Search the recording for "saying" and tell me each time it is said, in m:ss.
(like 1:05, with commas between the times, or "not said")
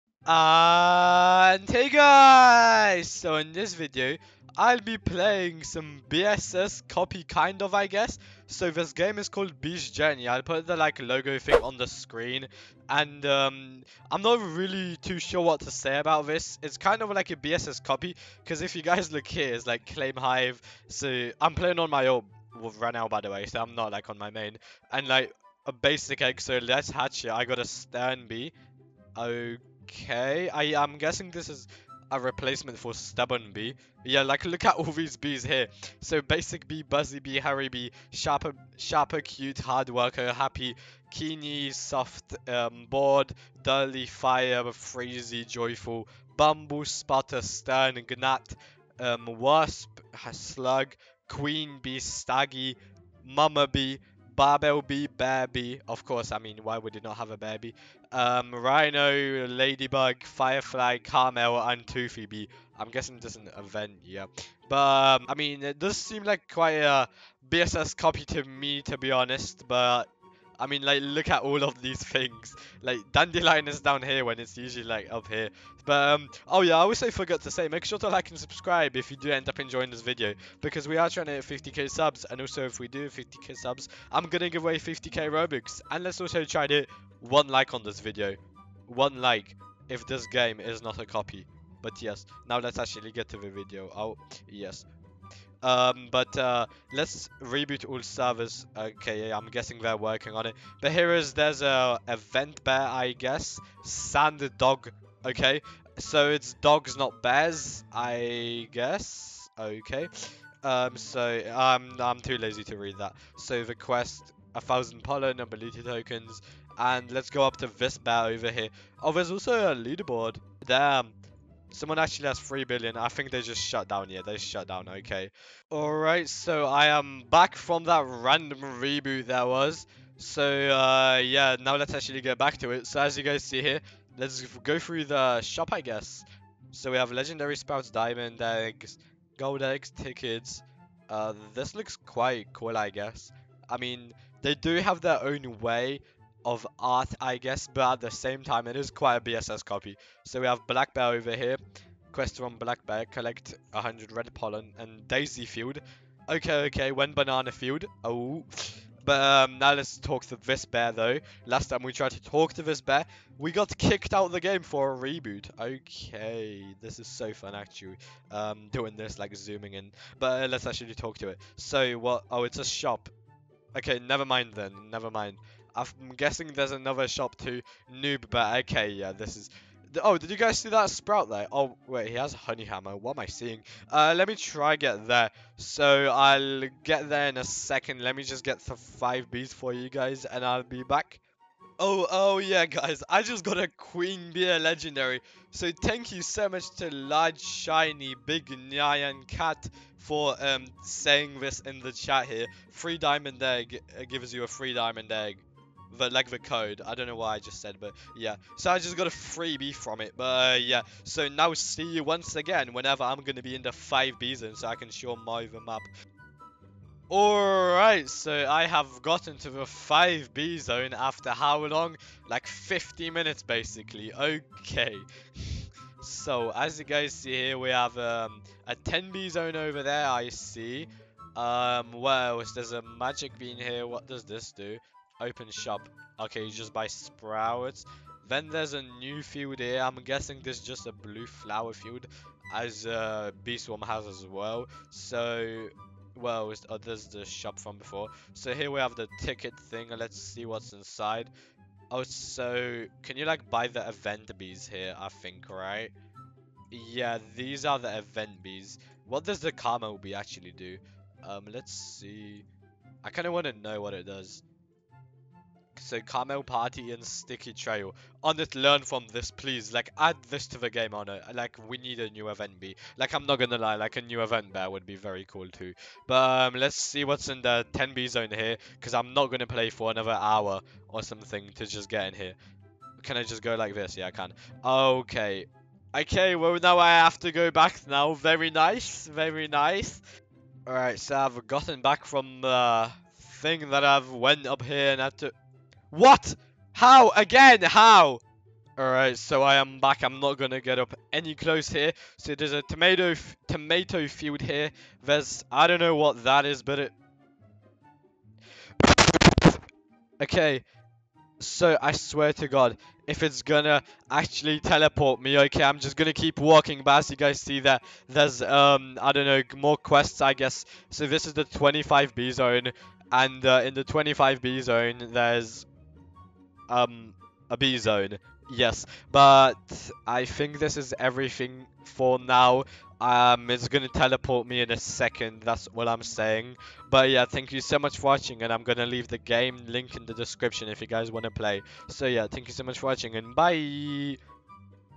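3:20, 5:36.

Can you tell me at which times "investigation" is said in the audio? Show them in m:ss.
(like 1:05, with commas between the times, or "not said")
not said.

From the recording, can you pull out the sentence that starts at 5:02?
So there's a tomato tomato field here.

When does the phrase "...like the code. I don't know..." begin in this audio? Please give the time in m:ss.
3:26.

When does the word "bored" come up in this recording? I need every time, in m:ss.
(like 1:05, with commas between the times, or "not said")
0:42.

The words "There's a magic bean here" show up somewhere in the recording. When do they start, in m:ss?
3:52.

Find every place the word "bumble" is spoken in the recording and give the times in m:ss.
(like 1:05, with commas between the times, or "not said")
0:46.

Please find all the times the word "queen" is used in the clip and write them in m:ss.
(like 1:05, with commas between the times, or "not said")
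0:51, 3:13.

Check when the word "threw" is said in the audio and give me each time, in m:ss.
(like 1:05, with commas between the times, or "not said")
not said.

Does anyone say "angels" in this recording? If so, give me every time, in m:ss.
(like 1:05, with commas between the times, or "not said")
not said.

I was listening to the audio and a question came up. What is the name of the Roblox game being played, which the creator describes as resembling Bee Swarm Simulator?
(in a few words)
Bees Journey.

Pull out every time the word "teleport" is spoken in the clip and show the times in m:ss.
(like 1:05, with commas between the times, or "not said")
5:14, 5:33.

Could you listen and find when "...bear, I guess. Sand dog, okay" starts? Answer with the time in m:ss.
1:42.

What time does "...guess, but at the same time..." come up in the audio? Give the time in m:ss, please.
2:27.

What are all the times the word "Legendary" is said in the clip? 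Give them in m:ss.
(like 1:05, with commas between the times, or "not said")
2:17, 3:14.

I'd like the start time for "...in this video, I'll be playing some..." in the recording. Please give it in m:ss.
0:03.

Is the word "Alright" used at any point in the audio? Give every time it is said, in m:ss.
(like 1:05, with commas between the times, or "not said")
2:05, 3:37, 4:50, 4:58.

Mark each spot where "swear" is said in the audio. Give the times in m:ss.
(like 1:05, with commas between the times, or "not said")
5:11.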